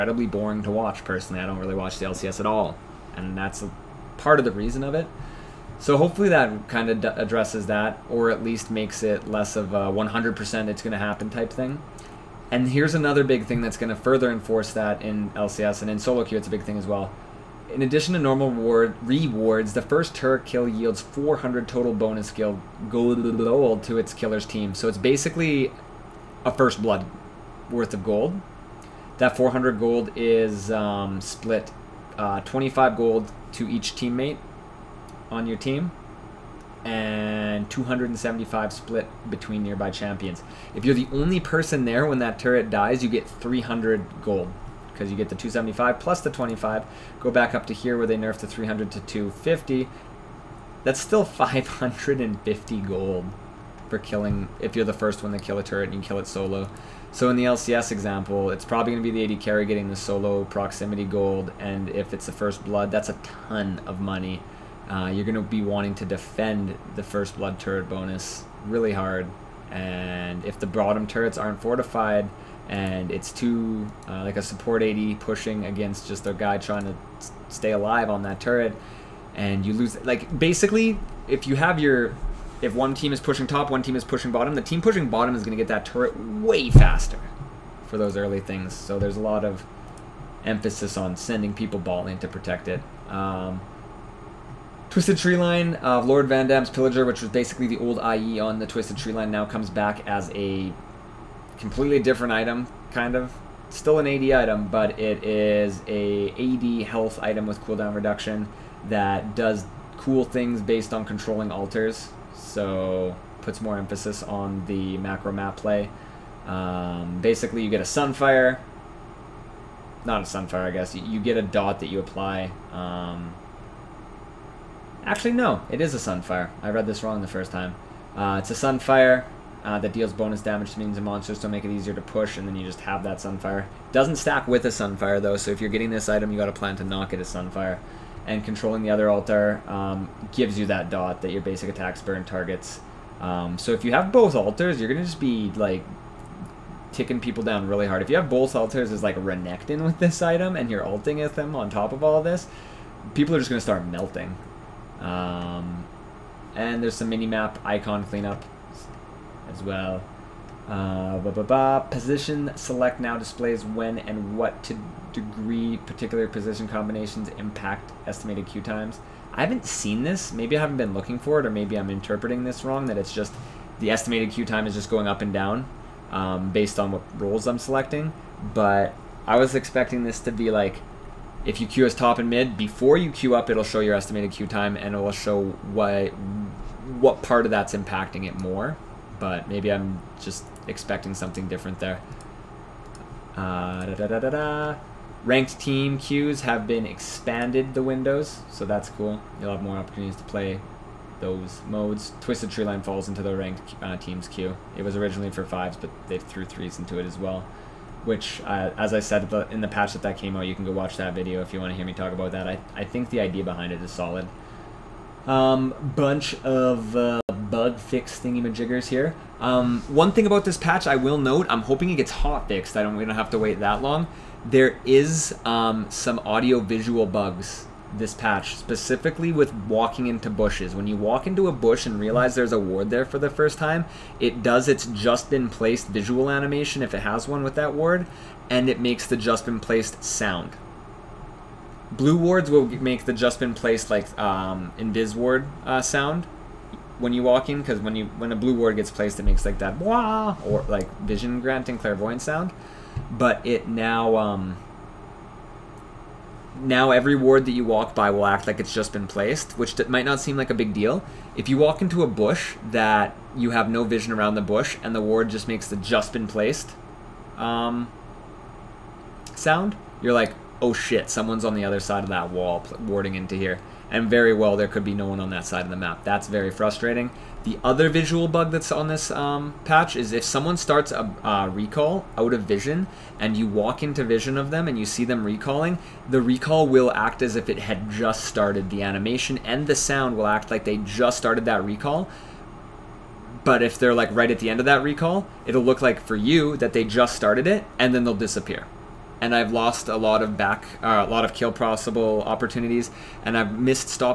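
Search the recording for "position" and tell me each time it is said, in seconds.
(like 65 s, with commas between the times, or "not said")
161 s, 166 s.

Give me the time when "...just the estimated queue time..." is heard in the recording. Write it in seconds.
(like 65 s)
173 s.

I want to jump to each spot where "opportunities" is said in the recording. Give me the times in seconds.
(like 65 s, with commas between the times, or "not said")
199 s, 302 s.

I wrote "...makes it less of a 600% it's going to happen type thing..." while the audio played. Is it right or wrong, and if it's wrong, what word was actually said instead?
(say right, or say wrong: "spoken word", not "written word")
wrong: "100", not "600".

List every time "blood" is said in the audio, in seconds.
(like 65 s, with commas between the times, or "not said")
26 s, 62 s, 67 s.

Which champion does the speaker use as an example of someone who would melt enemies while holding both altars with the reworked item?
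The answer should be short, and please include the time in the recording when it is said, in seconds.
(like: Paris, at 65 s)
Renekton, at 149 s.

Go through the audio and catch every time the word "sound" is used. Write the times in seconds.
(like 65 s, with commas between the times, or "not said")
240 s, 245 s, 252 s, 269 s, 289 s.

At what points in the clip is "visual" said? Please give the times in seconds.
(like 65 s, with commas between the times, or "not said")
226 s, 235 s, 277 s.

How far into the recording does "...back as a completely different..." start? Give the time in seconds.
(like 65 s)
99 s.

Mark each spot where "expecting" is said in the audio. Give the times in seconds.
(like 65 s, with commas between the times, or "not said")
179 s, 190 s.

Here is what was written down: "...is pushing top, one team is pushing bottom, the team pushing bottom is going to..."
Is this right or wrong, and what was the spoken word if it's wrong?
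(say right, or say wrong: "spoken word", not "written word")
right.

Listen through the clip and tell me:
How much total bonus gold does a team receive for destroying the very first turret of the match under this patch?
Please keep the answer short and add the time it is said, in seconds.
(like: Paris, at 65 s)
400, at 20 s.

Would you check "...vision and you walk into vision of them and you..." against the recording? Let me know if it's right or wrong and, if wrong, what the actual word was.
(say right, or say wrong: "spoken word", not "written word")
right.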